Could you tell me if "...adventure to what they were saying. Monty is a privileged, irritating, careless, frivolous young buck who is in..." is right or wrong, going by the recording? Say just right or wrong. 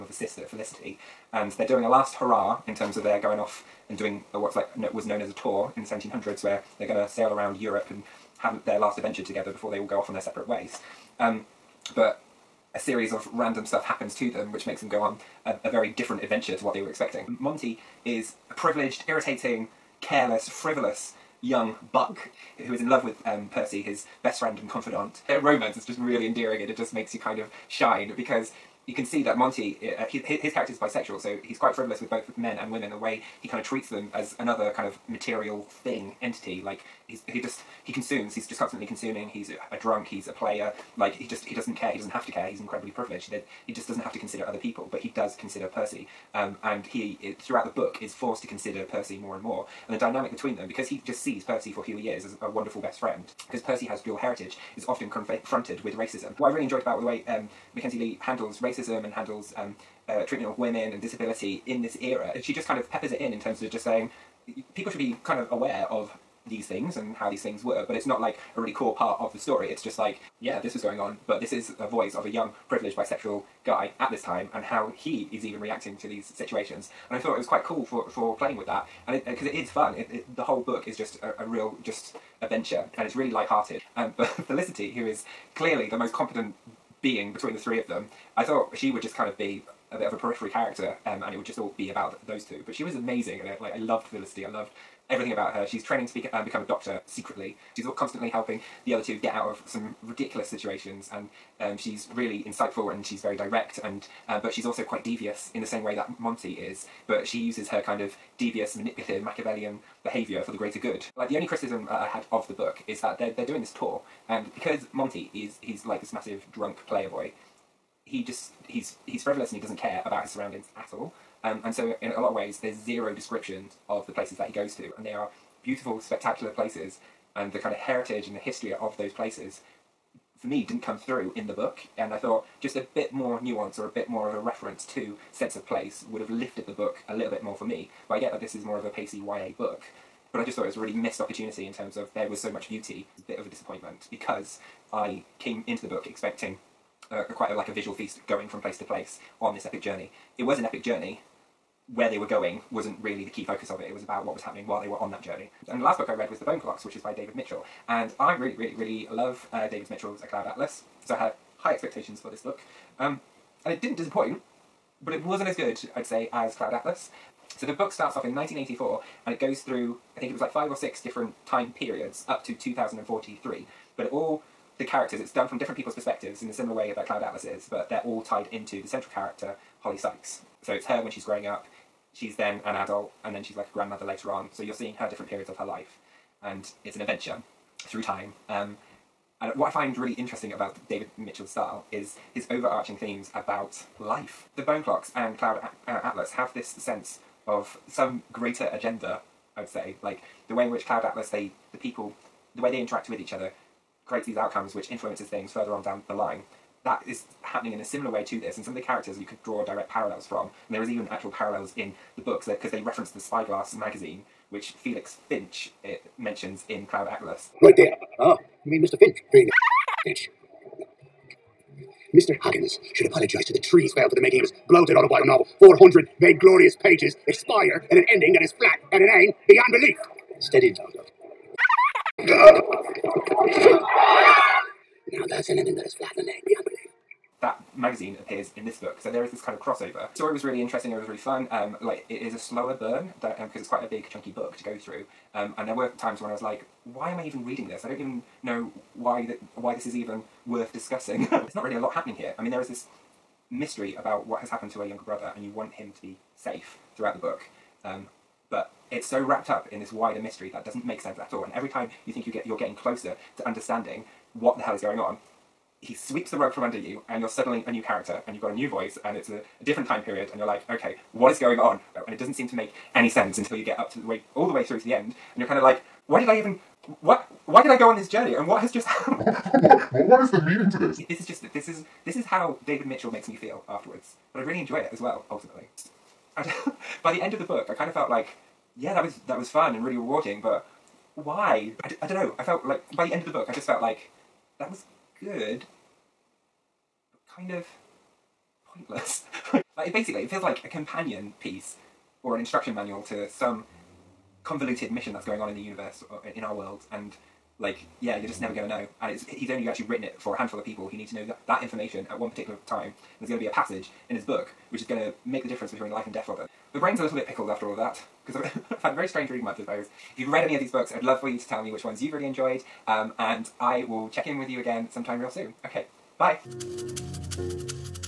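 wrong.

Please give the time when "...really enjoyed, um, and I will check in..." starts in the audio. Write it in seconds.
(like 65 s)
322 s.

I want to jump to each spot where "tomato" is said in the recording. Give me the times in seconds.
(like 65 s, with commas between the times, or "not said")
not said.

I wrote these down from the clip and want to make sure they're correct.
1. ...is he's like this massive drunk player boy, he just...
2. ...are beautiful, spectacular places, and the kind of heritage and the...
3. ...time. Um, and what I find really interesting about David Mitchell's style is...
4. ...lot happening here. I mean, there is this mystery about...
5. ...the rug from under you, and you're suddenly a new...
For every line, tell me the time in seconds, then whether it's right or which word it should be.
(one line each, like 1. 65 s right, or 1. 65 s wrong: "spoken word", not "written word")
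1. 115 s right
2. 125 s right
3. 188 s right
4. 251 s right
5. 266 s right.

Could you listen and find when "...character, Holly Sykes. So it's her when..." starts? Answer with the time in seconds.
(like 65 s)
179 s.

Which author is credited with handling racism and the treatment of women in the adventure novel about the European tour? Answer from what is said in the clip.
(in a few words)
Mackenzie Lee.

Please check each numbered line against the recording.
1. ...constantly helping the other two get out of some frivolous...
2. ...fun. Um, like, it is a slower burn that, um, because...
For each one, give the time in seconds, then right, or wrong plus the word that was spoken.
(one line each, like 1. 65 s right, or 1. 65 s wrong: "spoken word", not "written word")
1. 97 s wrong: "ridiculous", not "frivolous"
2. 241 s right.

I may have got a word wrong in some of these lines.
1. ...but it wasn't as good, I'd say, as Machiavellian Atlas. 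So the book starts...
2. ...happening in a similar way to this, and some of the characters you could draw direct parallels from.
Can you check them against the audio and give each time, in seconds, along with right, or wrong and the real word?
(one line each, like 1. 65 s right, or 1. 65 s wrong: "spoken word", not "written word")
1. 165 s wrong: "Cloud", not "Machiavellian"
2. 207 s right.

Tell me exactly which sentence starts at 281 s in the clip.
This is just this is this is how David Mitchell makes me feel afterwards, but I really enjoy it as well.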